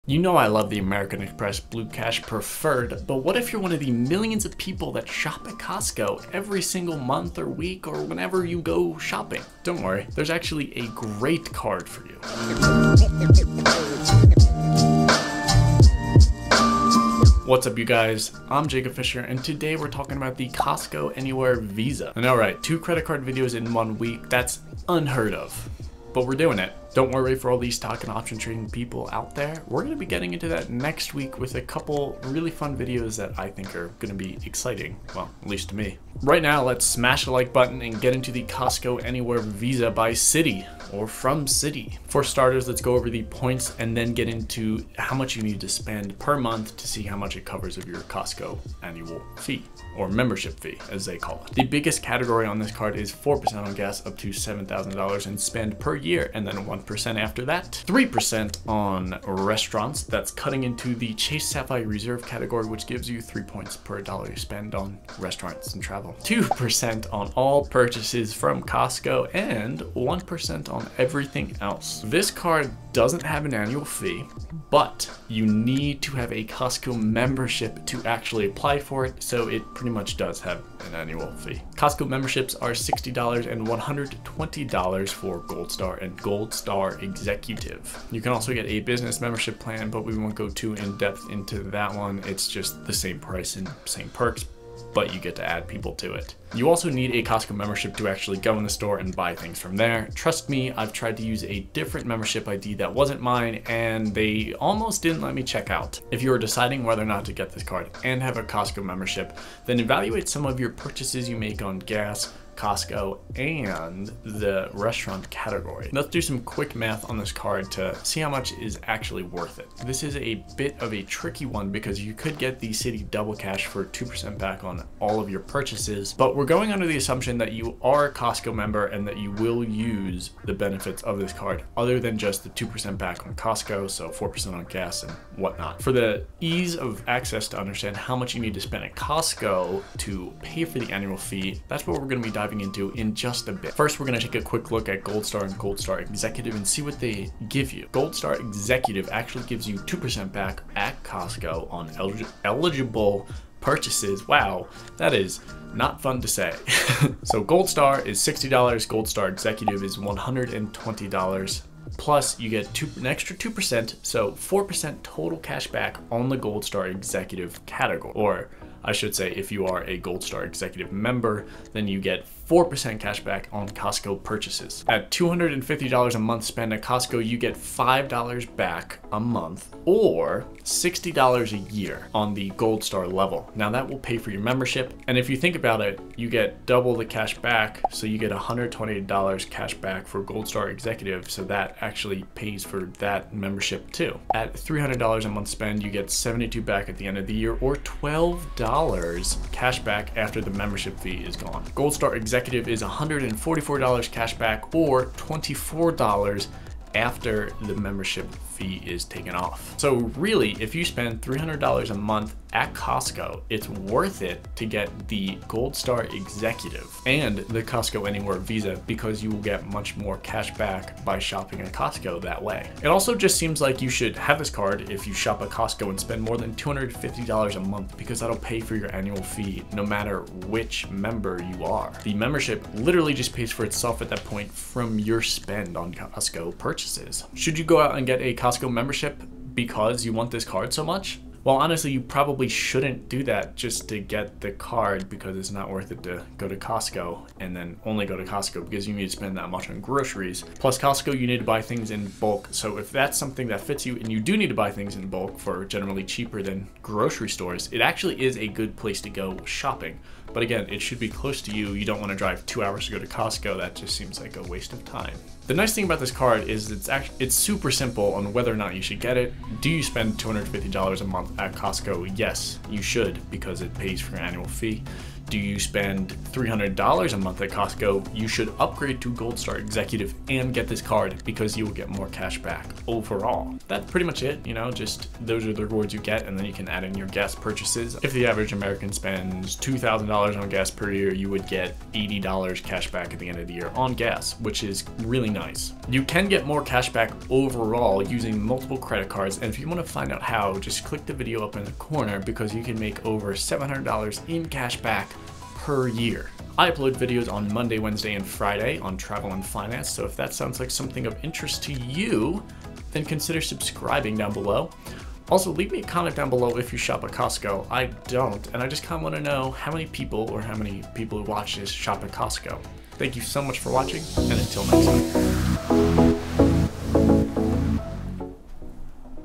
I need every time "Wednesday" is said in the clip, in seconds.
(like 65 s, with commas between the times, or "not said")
307 s.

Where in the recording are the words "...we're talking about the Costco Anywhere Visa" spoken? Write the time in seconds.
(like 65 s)
19 s.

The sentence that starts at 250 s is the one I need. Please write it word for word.
Plus Costco, you need to buy things in bulk.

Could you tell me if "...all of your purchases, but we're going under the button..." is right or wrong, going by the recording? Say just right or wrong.
wrong.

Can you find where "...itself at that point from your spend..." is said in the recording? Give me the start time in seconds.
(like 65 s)
233 s.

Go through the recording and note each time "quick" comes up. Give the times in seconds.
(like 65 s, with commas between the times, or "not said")
116 s, 144 s.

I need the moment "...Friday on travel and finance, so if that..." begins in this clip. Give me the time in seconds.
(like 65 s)
308 s.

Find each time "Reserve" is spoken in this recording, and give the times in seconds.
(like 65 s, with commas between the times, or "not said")
61 s.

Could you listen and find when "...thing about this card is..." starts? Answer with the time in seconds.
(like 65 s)
265 s.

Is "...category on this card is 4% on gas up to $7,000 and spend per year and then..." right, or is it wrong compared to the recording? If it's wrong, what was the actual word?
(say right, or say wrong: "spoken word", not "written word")
right.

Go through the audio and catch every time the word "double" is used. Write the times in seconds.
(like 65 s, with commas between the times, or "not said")
123 s, 186 s.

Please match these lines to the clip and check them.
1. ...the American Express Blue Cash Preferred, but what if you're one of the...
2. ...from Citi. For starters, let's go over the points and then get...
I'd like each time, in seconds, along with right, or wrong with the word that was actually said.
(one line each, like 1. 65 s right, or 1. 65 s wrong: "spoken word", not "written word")
1. 0 s right
2. 41 s right.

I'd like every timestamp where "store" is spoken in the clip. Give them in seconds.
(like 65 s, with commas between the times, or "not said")
98 s, 257 s.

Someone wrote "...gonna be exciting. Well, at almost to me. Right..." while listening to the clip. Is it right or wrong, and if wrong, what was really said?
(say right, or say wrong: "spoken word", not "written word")
wrong: "least", not "almost".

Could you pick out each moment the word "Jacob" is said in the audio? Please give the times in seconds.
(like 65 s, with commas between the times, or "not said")
18 s.